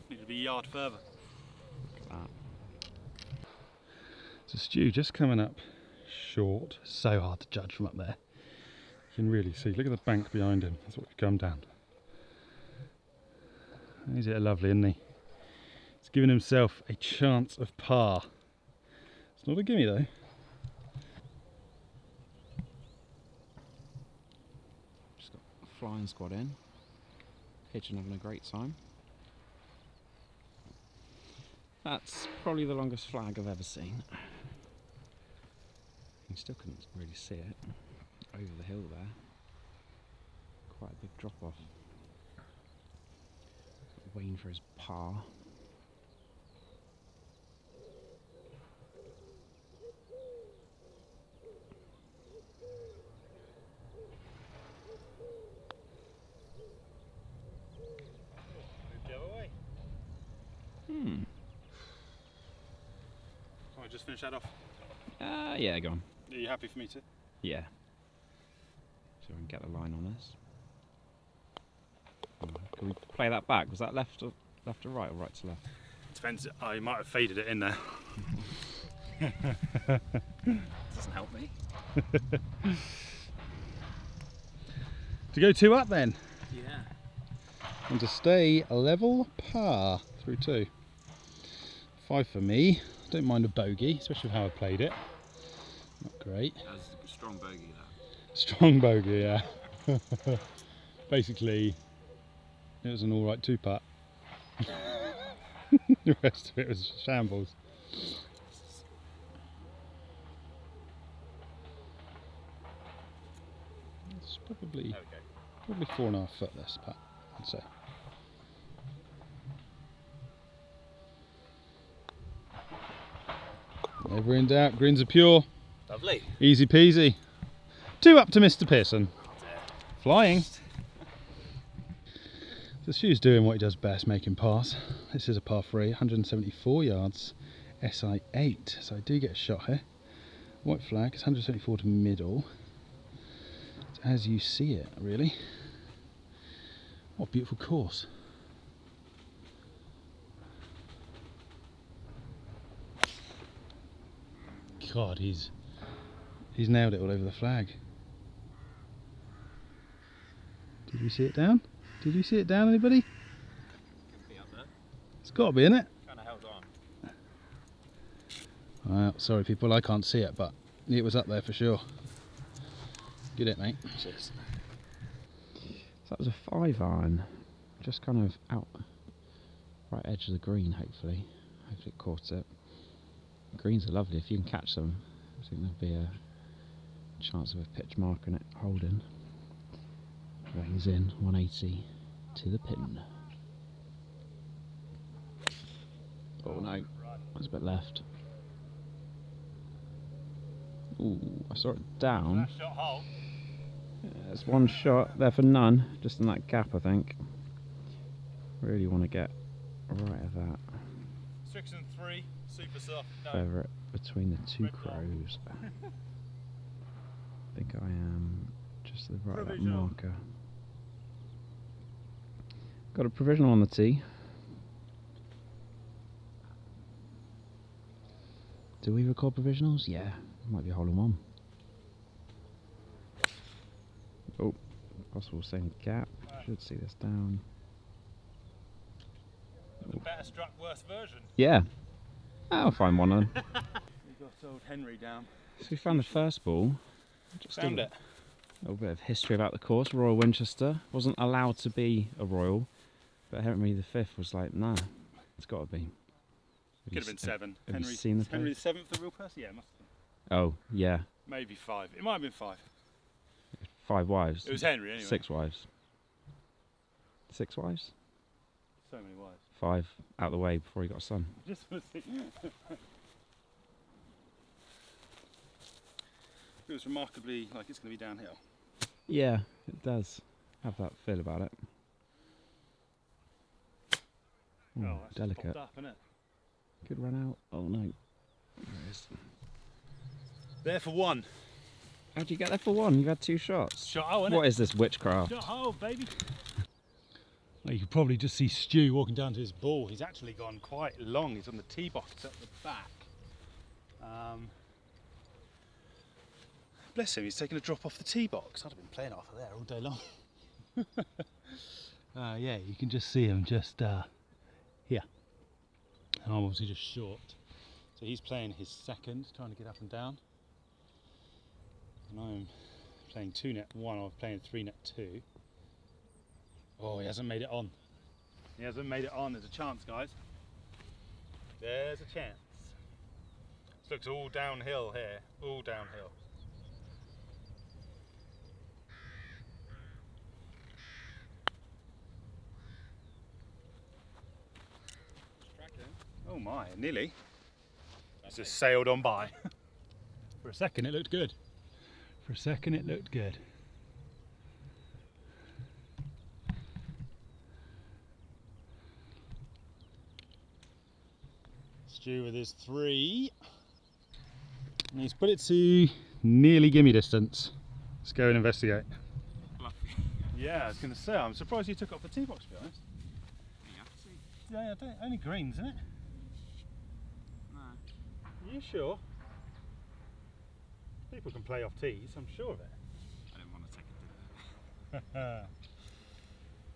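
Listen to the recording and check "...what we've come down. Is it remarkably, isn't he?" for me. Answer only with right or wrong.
wrong.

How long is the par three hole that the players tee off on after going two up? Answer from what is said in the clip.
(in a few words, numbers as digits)
174 yards.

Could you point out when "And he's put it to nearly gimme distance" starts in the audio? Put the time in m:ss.
6:04.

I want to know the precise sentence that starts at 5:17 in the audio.
So he's playing his second, trying to get up and down.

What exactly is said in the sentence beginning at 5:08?
I'd have been playing off of there all day long.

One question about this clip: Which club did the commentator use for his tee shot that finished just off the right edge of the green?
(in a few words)
5 iron.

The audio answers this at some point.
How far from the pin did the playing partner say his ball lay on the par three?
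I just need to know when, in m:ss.
3:11.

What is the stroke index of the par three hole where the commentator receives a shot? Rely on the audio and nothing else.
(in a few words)
8.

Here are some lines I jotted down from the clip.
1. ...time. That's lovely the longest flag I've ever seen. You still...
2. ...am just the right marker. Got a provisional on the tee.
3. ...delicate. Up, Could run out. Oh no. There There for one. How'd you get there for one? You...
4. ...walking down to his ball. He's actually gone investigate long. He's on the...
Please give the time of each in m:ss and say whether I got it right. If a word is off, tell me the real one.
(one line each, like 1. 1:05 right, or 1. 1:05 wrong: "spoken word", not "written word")
1. 0:28 wrong: "probably", not "lovely"
2. 3:37 right
3. 4:45 right
4. 4:58 wrong: "quite", not "investigate".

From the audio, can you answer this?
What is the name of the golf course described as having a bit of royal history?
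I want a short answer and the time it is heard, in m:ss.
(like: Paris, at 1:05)
Royal Winchester, at 4:09.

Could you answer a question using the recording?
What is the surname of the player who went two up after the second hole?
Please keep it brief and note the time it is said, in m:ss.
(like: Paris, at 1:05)
Pearson, at 2:08.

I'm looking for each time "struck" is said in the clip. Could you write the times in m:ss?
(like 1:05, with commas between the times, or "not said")
4:00.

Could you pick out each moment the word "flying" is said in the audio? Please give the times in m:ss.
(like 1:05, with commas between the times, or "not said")
0:25, 2:10.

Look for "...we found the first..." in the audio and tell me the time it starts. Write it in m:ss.
4:05.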